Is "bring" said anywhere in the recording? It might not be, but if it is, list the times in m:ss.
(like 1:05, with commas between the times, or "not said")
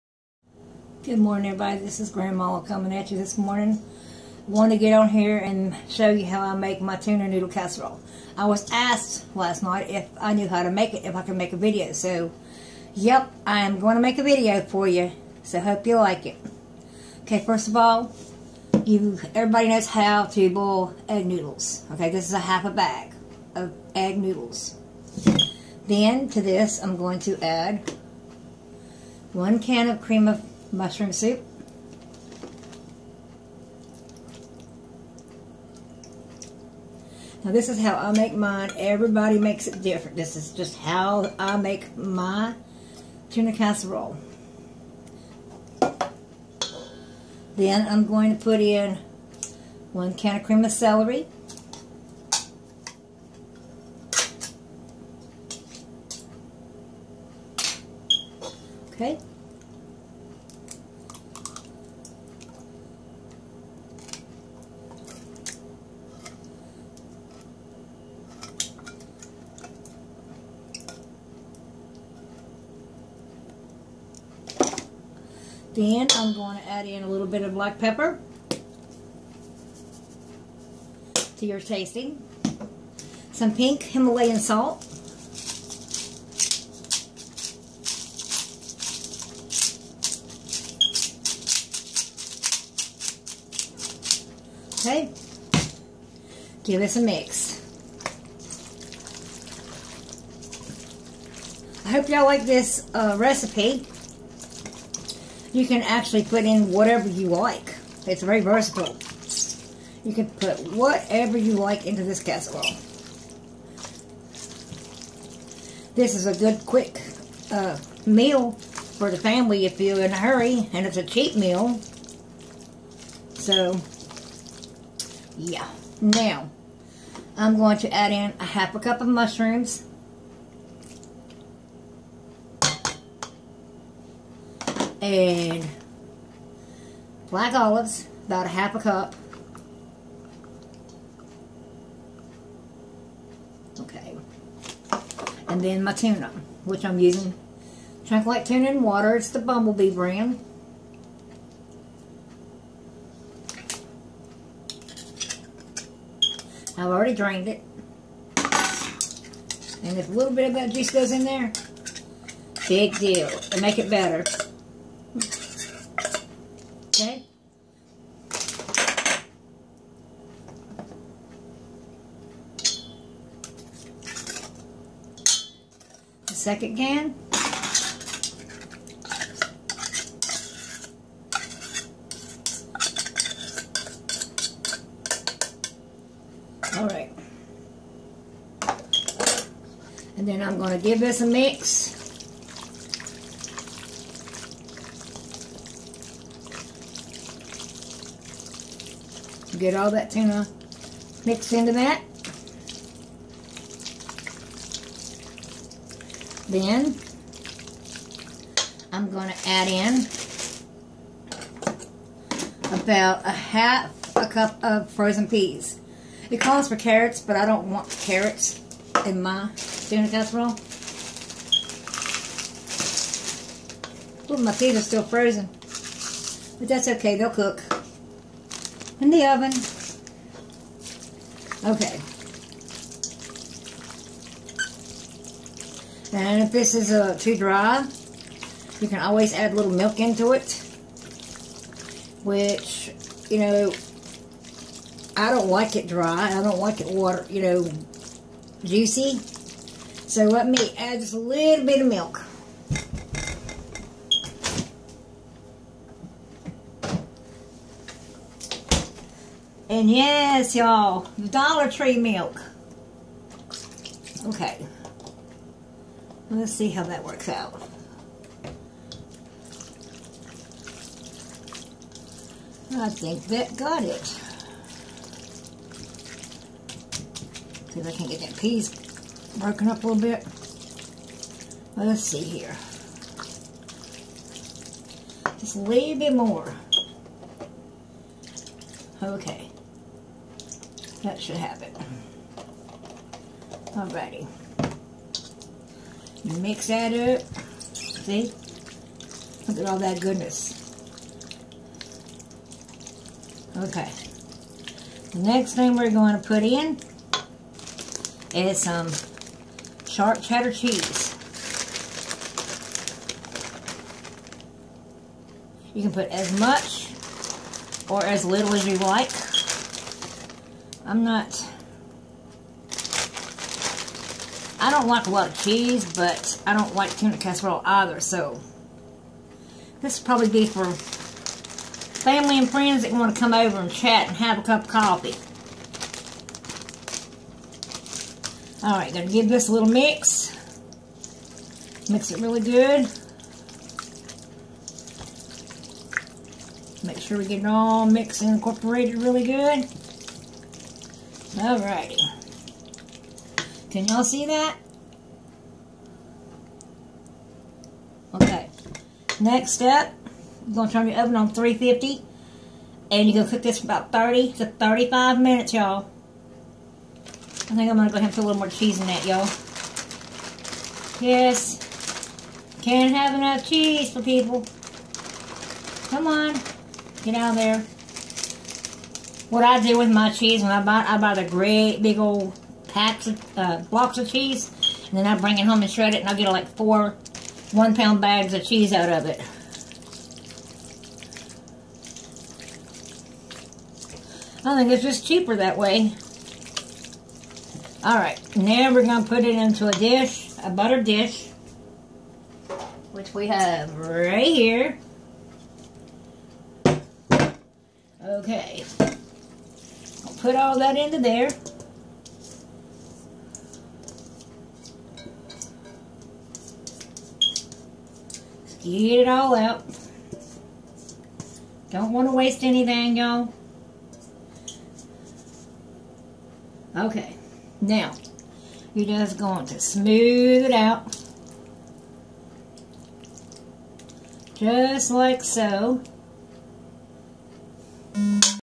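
6:25.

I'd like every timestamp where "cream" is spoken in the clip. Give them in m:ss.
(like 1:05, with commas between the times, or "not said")
0:29, 0:50.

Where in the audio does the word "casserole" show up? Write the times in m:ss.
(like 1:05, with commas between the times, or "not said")
0:07, 0:43, 1:52, 3:40, 5:27.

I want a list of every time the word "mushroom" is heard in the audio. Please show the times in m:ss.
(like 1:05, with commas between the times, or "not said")
0:30, 2:09.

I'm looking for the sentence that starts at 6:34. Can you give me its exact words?
I think it's just cheaper that way.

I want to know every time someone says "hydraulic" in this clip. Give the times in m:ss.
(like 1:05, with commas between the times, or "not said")
not said.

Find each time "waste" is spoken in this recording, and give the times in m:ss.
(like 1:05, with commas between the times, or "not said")
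7:02.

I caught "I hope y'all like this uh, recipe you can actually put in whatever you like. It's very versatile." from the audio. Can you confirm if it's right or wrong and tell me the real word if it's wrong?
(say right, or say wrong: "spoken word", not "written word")
right.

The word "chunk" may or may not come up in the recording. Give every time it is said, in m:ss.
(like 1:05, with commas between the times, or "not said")
2:28.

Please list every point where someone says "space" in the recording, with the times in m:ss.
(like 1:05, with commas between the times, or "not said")
not said.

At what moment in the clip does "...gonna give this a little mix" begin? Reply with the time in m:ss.
5:38.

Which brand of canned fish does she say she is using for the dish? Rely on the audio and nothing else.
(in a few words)
Bumblebee.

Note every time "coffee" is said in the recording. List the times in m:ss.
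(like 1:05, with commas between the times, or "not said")
5:34.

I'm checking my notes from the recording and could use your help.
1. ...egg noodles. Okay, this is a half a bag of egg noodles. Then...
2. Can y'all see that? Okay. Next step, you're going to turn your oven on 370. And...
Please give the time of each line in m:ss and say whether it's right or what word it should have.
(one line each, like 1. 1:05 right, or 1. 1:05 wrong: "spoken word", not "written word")
1. 0:21 right
2. 5:53 wrong: "350", not "370".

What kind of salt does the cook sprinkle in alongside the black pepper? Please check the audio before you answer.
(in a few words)
pink Himalayan salt.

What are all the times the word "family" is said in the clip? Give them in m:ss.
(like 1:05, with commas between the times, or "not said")
1:59, 5:30.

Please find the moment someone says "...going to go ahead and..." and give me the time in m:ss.
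6:07.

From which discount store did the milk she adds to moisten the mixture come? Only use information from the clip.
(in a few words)
Dollar Tree.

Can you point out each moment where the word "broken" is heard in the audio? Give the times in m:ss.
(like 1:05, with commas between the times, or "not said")
4:39.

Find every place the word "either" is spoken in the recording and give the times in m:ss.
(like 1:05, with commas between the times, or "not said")
5:27.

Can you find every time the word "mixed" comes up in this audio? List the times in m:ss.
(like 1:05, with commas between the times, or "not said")
3:21, 5:47.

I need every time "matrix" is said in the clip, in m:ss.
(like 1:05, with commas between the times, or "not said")
not said.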